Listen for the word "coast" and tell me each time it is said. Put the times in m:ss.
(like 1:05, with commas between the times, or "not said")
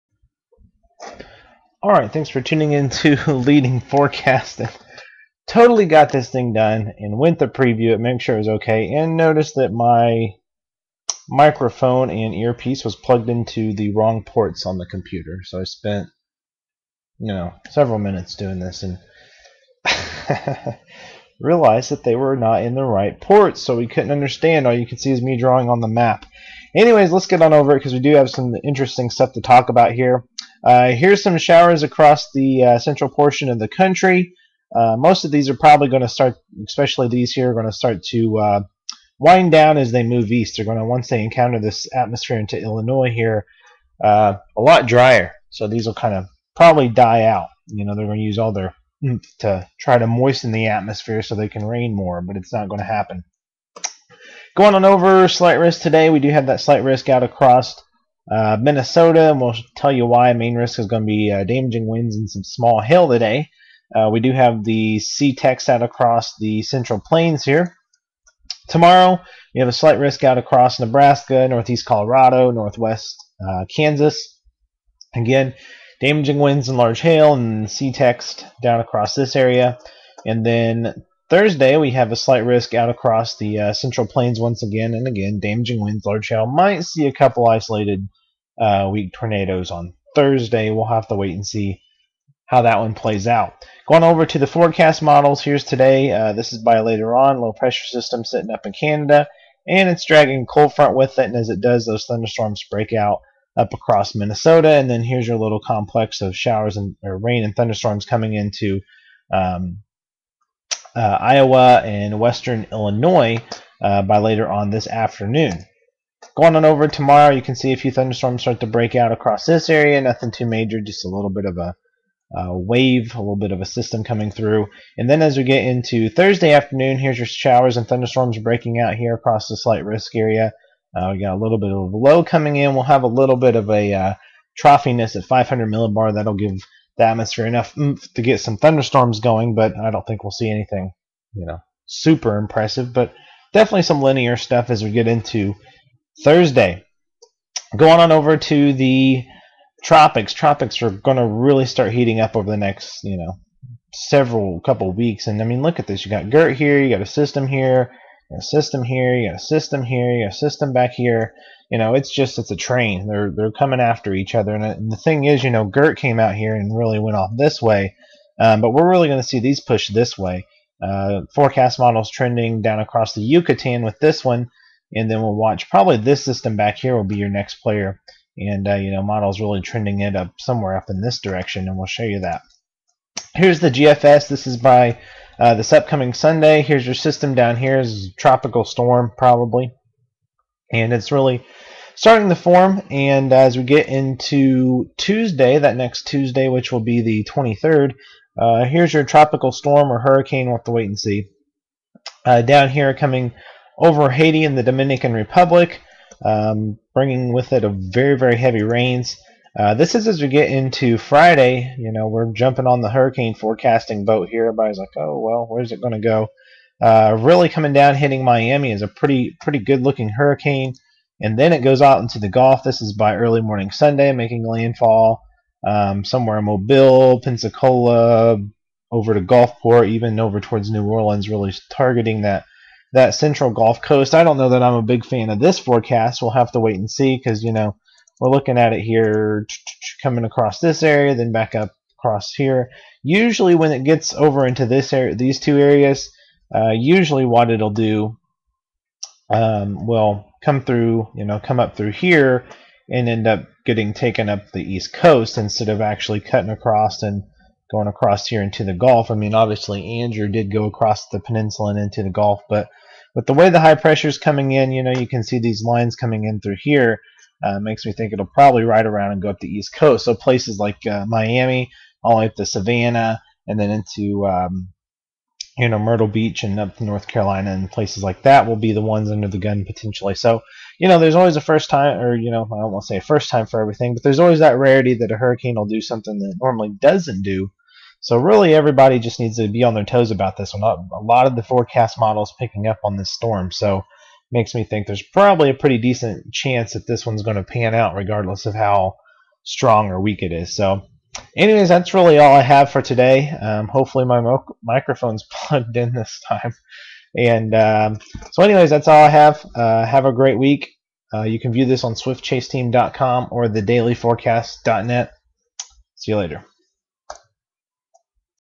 3:53, 4:14, 4:29.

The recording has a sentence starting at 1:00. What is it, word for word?
Main risk is going to be uh, damaging winds and some small hail today.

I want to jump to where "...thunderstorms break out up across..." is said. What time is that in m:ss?
1:42.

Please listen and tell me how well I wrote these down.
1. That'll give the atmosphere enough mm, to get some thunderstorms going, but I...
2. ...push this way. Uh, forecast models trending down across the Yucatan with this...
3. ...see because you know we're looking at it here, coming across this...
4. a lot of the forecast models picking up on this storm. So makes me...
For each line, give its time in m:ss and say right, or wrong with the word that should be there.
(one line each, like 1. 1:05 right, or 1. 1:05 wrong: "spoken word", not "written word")
1. 2:16 right
2. 2:49 right
3. 3:56 right
4. 4:50 right.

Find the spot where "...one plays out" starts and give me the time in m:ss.
1:32.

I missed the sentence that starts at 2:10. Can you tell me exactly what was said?
Uh, we got a little bit of low coming in.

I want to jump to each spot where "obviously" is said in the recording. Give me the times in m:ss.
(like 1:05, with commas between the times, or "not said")
4:19.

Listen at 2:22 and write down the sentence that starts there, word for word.
But definitely some linear stuff as we get into Thursday.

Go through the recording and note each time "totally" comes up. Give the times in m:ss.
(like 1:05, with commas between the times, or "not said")
0:05.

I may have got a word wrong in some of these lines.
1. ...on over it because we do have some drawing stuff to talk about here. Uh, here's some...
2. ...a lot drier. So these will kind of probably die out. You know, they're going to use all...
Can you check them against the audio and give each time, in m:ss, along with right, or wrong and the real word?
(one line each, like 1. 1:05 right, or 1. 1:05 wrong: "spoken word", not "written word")
1. 0:27 wrong: "interesting", not "drawing"
2. 0:44 right.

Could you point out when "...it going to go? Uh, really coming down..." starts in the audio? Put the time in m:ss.
3:35.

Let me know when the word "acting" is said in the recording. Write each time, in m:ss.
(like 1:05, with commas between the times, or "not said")
not said.